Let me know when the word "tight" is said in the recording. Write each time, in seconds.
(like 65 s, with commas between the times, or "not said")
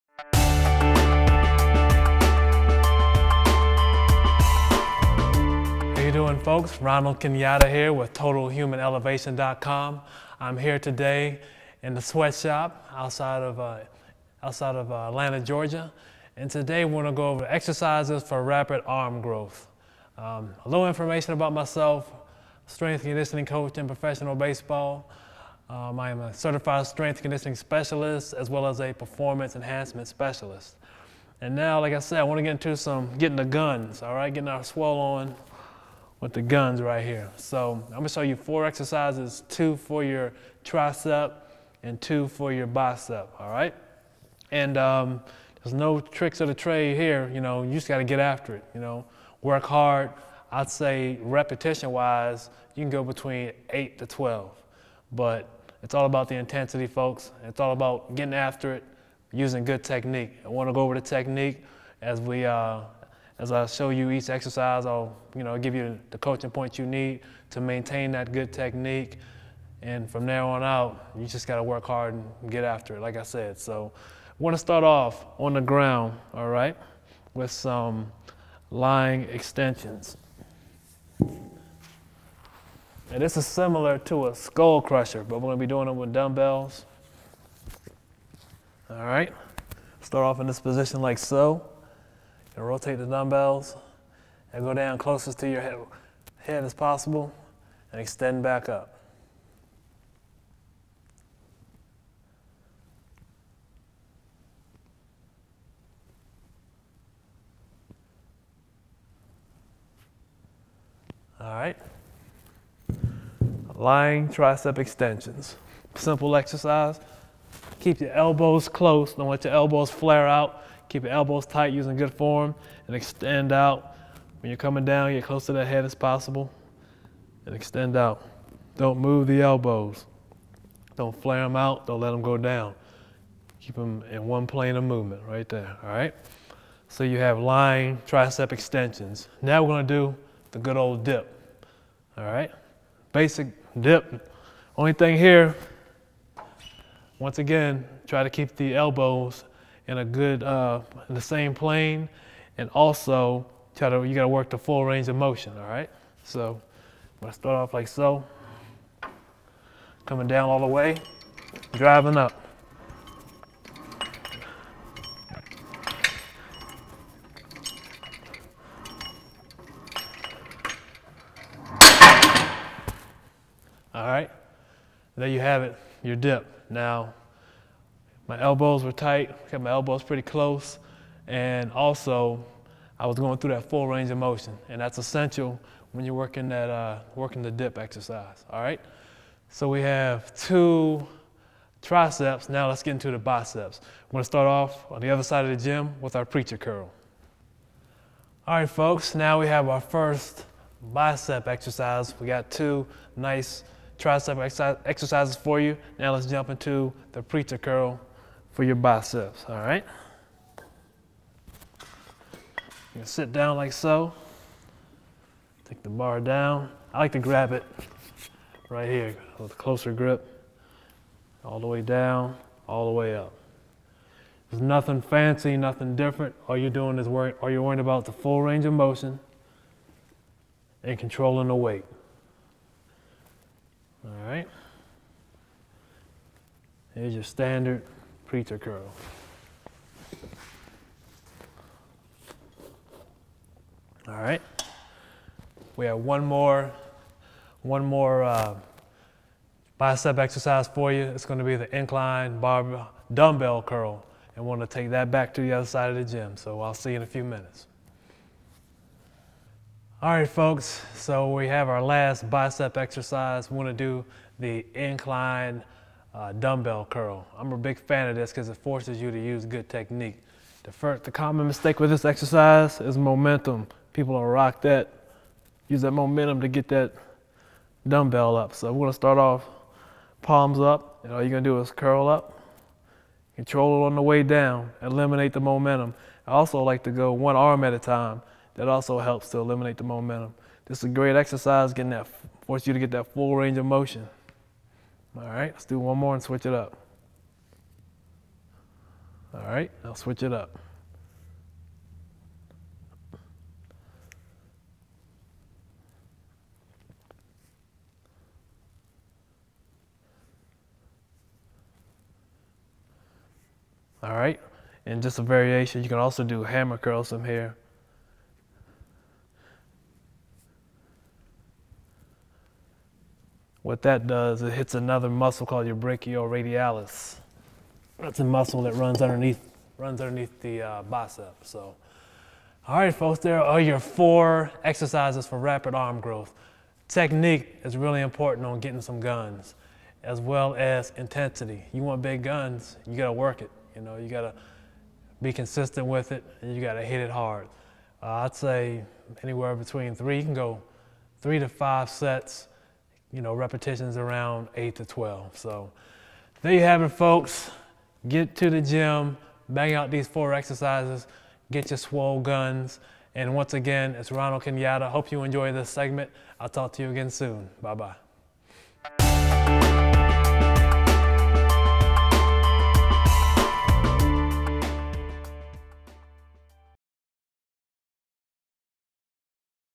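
121 s, 178 s.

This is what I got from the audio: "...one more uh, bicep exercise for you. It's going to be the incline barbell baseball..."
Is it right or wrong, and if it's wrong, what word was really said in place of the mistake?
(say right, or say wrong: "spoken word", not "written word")
wrong: "dumbbell", not "baseball".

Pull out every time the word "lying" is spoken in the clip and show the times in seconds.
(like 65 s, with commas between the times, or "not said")
78 s, 113 s, 137 s.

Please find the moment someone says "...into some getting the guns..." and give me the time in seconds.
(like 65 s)
32 s.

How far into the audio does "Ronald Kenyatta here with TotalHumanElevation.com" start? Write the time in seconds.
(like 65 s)
6 s.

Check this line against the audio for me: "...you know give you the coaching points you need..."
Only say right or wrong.
right.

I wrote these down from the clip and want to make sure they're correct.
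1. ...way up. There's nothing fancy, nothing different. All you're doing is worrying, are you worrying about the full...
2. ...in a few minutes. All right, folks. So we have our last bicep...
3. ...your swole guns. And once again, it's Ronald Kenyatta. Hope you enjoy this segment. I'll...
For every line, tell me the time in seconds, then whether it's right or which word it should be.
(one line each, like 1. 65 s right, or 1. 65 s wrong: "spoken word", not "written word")
1. 222 s right
2. 256 s right
3. 361 s right.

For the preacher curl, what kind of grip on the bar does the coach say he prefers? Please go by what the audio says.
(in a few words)
closer grip.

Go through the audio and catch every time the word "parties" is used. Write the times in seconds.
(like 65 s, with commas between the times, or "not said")
not said.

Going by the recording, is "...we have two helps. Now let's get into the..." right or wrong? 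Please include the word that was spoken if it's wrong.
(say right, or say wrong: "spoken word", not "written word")
wrong: "triceps", not "helps".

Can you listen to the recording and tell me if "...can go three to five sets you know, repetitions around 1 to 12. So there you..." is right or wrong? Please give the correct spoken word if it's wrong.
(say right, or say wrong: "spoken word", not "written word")
wrong: "8", not "1".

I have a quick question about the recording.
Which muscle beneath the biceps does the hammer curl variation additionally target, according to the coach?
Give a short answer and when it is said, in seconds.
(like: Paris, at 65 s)
brachioradialis, at 325 s.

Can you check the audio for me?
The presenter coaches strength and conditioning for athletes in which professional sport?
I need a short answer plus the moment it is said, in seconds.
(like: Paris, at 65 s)
baseball, at 23 s.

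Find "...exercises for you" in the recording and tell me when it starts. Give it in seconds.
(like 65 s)
204 s.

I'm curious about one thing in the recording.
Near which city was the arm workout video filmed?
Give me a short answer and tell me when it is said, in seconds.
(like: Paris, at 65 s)
Atlanta, Georgia, at 15 s.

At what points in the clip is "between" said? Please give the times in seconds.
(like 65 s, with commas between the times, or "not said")
53 s, 349 s.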